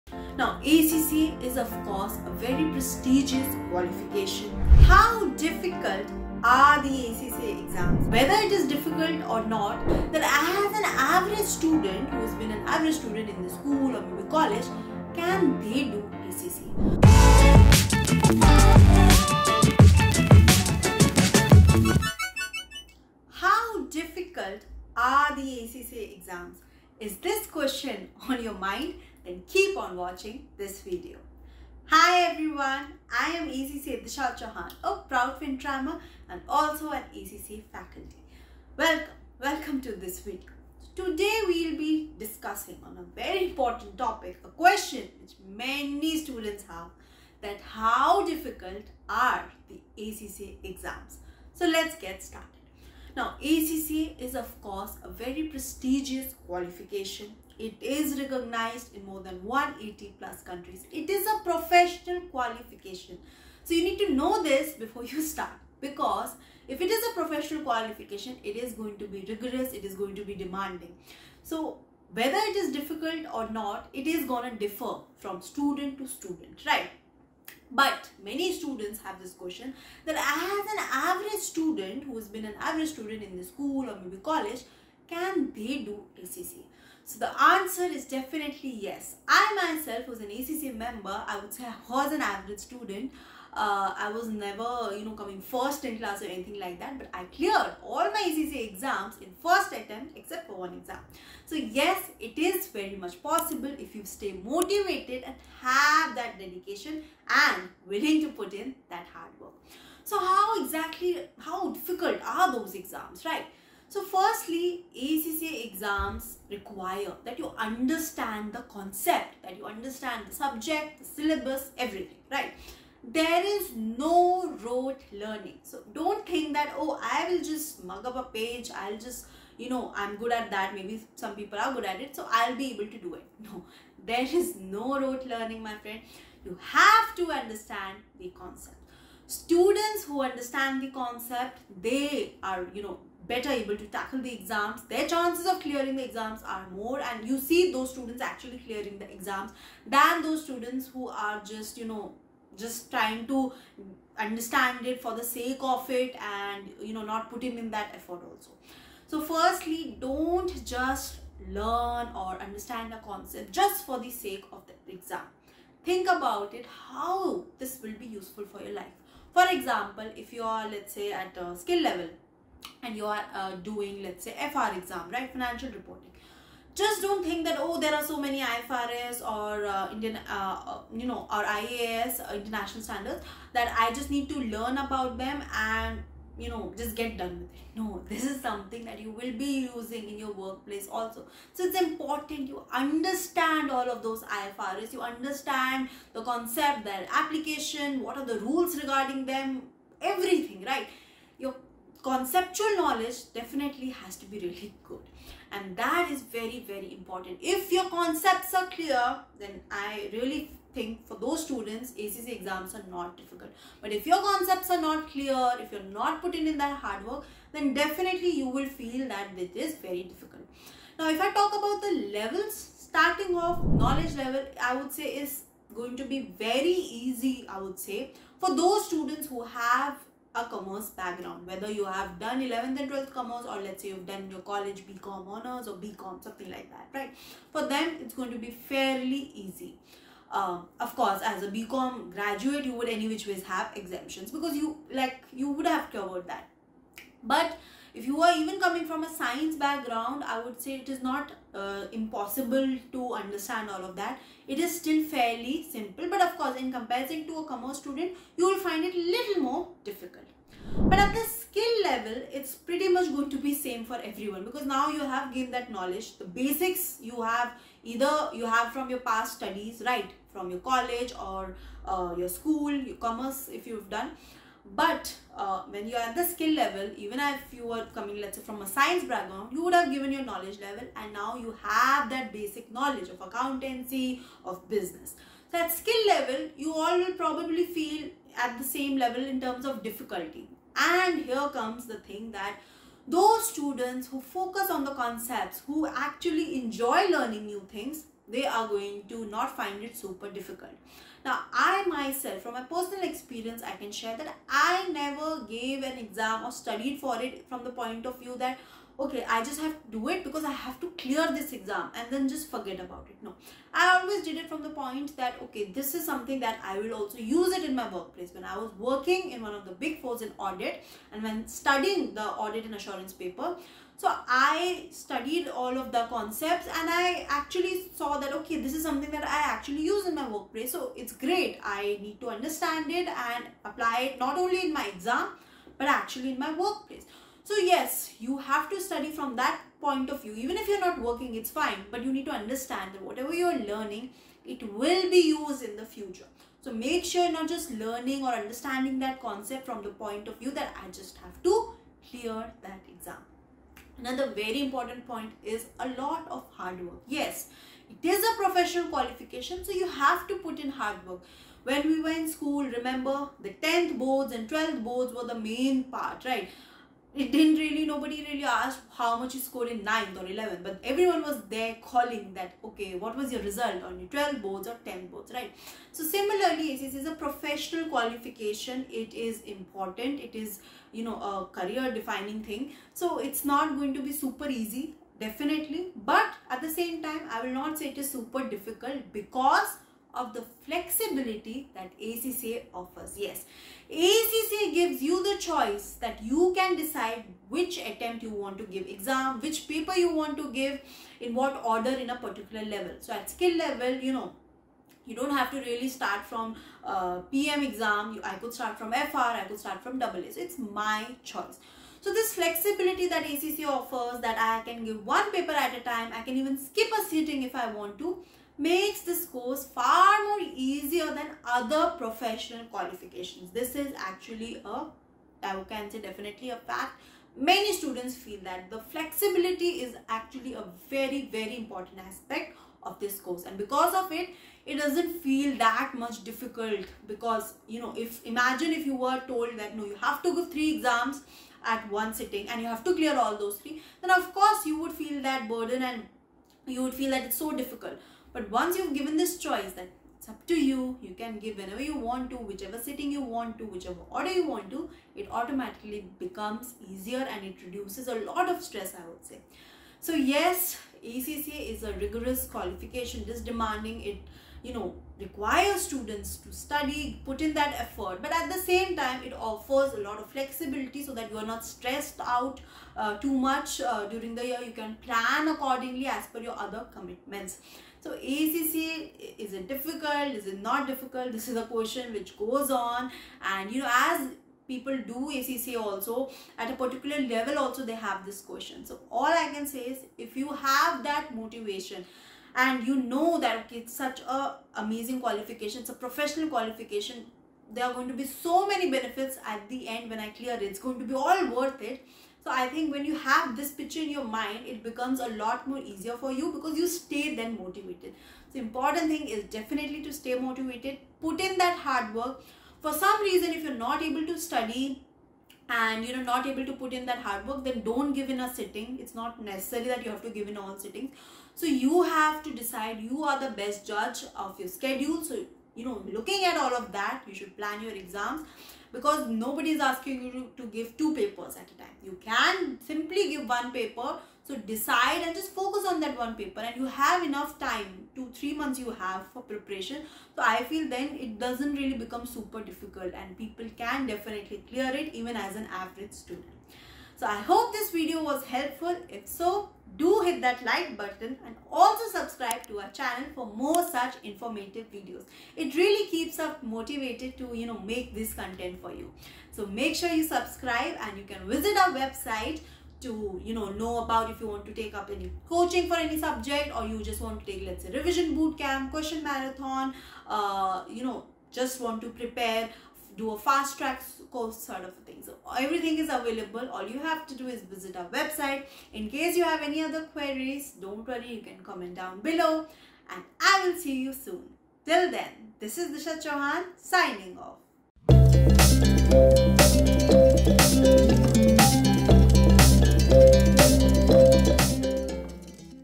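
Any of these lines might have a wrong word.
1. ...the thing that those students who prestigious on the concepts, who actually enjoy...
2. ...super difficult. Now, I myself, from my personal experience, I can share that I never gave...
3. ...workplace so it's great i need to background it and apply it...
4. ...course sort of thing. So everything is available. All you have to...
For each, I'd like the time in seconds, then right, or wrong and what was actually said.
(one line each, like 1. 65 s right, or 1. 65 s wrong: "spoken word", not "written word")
1. 291 s wrong: "focus", not "prestigious"
2. 299 s right
3. 330 s wrong: "understand", not "background"
4. 574 s right.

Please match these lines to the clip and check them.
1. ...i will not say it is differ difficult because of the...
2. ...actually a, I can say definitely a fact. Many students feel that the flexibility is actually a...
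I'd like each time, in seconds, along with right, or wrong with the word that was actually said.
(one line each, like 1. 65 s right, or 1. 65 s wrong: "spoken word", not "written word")
1. 387 s wrong: "super", not "differ"
2. 423 s right.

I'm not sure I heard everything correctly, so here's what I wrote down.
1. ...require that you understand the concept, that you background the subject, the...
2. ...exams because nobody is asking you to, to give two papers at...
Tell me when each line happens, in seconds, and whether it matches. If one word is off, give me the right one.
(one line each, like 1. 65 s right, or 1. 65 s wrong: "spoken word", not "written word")
1. 116 s wrong: "understand", not "background"
2. 527 s right.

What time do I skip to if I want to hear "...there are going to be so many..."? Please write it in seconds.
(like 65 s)
497 s.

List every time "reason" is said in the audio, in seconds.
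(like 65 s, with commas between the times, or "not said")
513 s.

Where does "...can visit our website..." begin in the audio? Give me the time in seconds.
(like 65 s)
561 s.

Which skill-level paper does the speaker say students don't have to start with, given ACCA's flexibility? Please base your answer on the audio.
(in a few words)
PM.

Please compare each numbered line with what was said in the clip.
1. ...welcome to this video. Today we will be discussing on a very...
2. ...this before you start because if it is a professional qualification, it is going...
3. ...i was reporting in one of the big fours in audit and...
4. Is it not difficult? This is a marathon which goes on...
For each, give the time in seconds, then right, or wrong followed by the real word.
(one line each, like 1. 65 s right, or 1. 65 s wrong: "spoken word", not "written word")
1. 39 s right
2. 64 s right
3. 318 s wrong: "working", not "reporting"
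4. 480 s wrong: "question", not "marathon".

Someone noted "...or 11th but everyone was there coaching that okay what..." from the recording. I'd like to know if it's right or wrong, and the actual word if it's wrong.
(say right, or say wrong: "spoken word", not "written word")
wrong: "calling", not "coaching".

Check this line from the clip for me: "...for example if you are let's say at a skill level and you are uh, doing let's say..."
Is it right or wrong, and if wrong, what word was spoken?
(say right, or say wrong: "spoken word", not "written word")
right.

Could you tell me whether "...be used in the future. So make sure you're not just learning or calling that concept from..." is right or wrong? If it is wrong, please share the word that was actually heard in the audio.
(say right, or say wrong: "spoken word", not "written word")
wrong: "understanding", not "calling".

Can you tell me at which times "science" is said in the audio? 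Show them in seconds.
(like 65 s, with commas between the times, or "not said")
249 s, 278 s.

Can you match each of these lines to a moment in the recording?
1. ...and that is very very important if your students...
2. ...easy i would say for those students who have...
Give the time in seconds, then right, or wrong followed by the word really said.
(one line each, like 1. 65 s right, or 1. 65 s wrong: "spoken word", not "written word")
1. 205 s wrong: "concepts", not "students"
2. 227 s right.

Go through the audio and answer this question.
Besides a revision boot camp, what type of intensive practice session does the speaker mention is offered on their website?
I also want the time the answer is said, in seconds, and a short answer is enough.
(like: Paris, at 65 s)
question marathon, at 568 s.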